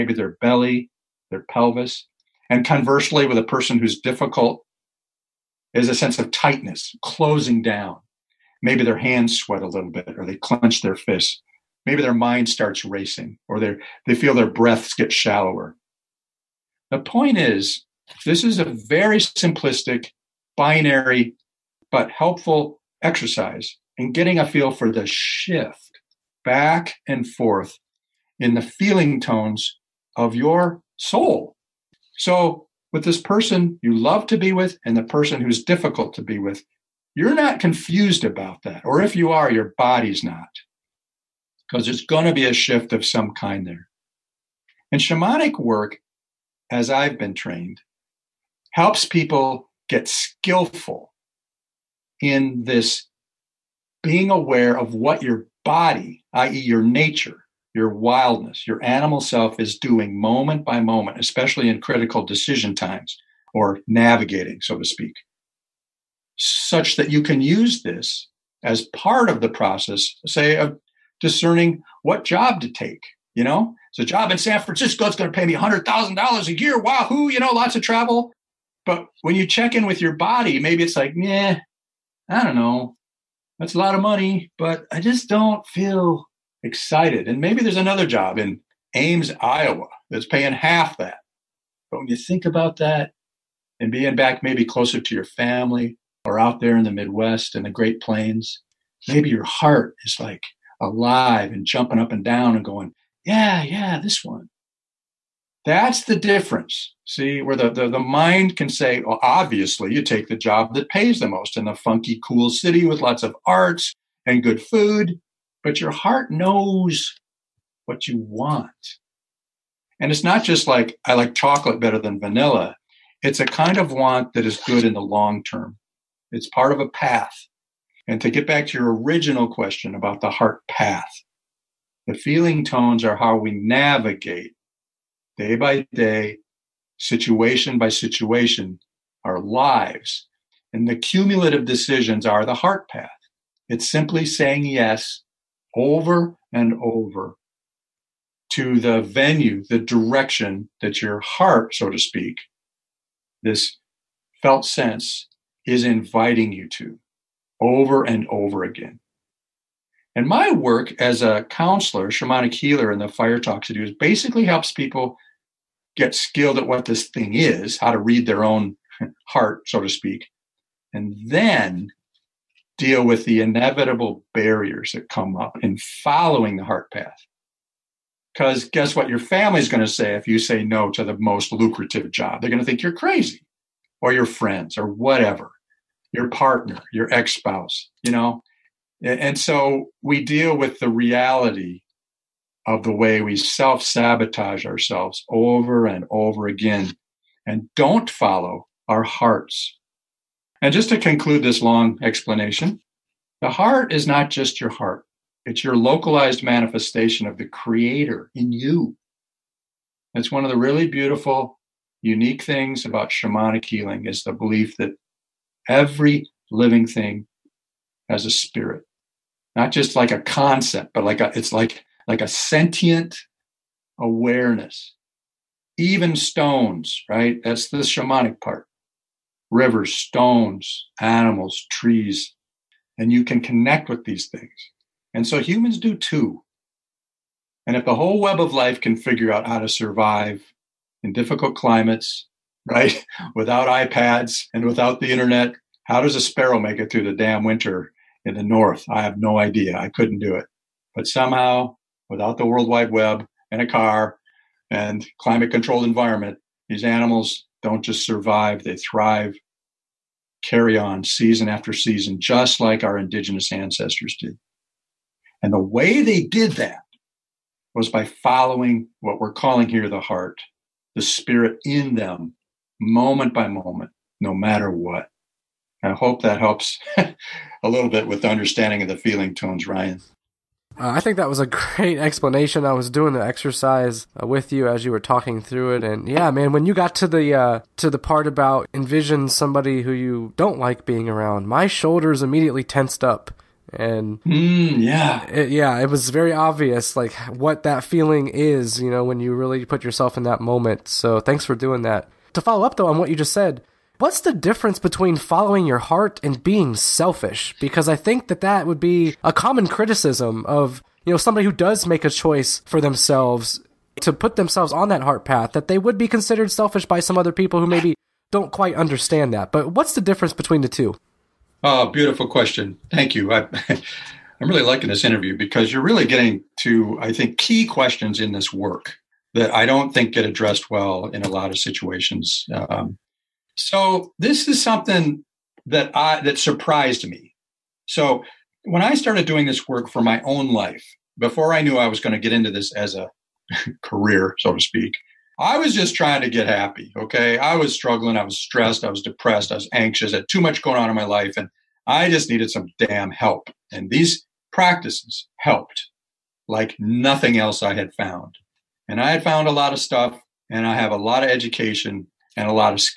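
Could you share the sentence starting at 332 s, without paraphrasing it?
Um, so this is something that I that surprised me.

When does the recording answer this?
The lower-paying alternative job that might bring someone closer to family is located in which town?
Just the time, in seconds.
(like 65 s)
88 s.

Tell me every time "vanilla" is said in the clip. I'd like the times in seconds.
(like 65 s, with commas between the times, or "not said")
122 s.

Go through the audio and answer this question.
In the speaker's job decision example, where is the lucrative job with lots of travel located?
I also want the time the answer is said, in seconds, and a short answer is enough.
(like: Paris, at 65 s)
San Francisco, at 74 s.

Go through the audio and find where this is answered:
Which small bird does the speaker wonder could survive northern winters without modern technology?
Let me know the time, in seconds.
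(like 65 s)
246 s.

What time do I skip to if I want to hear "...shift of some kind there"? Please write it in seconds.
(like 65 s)
42 s.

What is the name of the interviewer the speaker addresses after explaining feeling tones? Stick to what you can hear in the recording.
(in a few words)
Ryan.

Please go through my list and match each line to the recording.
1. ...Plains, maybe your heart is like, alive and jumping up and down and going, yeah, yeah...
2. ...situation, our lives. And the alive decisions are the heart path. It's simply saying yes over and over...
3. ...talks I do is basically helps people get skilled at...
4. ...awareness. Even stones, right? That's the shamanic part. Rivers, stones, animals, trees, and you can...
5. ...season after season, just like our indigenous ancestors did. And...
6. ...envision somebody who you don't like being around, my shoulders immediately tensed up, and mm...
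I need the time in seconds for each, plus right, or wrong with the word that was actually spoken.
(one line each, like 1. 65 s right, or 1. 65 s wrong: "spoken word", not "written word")
1. 98 s right
2. 137 s wrong: "cumulative", not "alive"
3. 163 s right
4. 223 s right
5. 261 s right
6. 288 s right.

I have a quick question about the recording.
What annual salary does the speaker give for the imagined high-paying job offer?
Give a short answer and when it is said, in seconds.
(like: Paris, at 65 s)
$100,000, at 75 s.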